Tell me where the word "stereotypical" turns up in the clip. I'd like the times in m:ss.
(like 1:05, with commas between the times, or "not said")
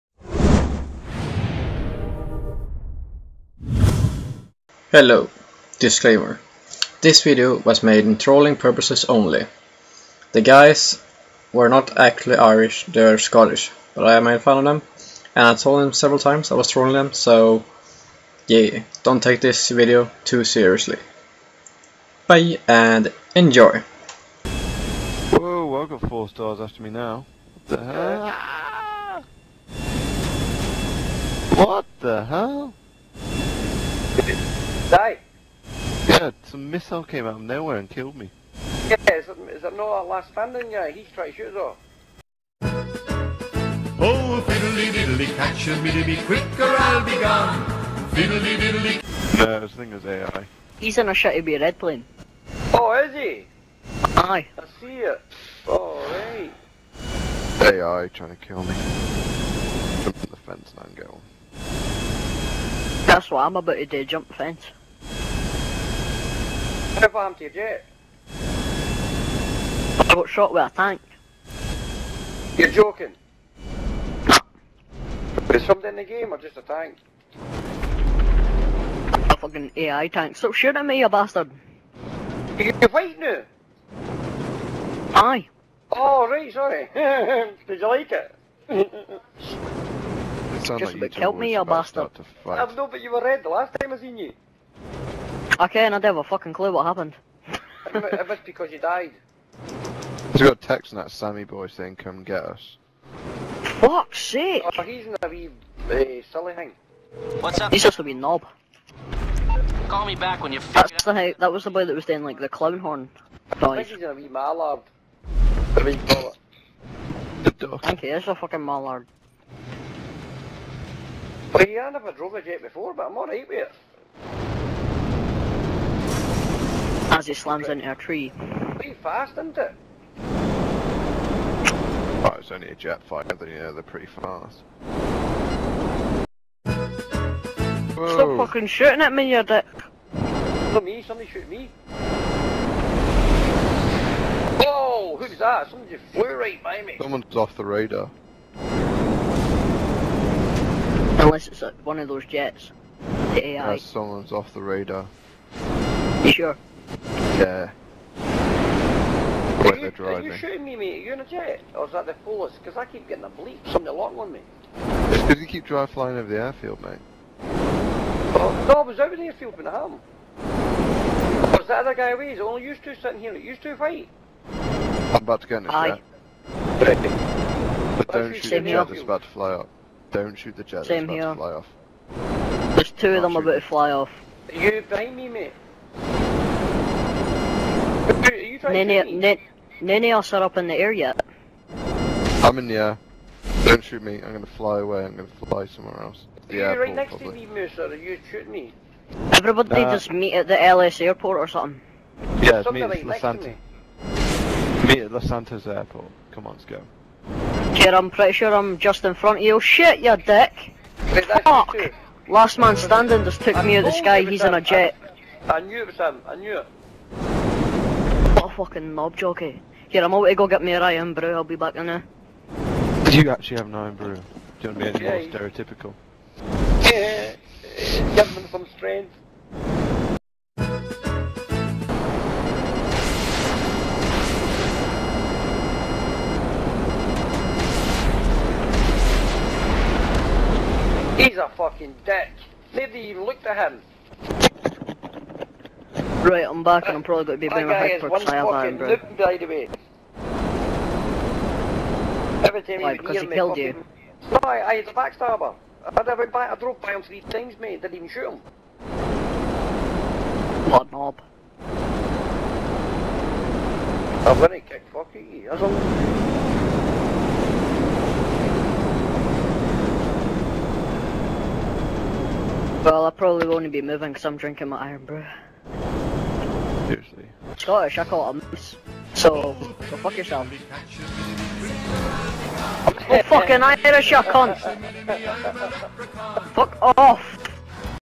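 3:45.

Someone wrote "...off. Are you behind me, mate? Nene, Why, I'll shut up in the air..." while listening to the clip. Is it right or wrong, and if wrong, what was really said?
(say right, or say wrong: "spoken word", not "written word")
wrong: "Nene", not "Why".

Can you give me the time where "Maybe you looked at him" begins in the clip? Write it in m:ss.
4:02.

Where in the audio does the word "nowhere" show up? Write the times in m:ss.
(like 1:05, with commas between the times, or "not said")
0:37.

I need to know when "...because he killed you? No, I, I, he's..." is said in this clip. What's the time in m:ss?
4:12.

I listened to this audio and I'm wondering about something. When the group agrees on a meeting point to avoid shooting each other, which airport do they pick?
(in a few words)
Los Santos airport.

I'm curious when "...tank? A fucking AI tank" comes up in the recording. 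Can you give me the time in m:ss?
1:16.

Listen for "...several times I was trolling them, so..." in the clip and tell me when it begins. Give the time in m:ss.
0:15.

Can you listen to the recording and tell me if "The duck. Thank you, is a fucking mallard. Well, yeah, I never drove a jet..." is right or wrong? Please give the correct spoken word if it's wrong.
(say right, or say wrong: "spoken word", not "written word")
right.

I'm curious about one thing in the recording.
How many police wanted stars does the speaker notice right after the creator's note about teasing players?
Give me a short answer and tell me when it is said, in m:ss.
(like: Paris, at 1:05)
4, at 0:26.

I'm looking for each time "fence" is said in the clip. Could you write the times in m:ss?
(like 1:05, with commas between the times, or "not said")
1:00, 1:04.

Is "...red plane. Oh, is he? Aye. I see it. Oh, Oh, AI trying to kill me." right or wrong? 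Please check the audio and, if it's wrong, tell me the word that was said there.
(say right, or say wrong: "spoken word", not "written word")
right.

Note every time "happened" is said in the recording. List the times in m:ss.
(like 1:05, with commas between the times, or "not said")
1:06, 1:36.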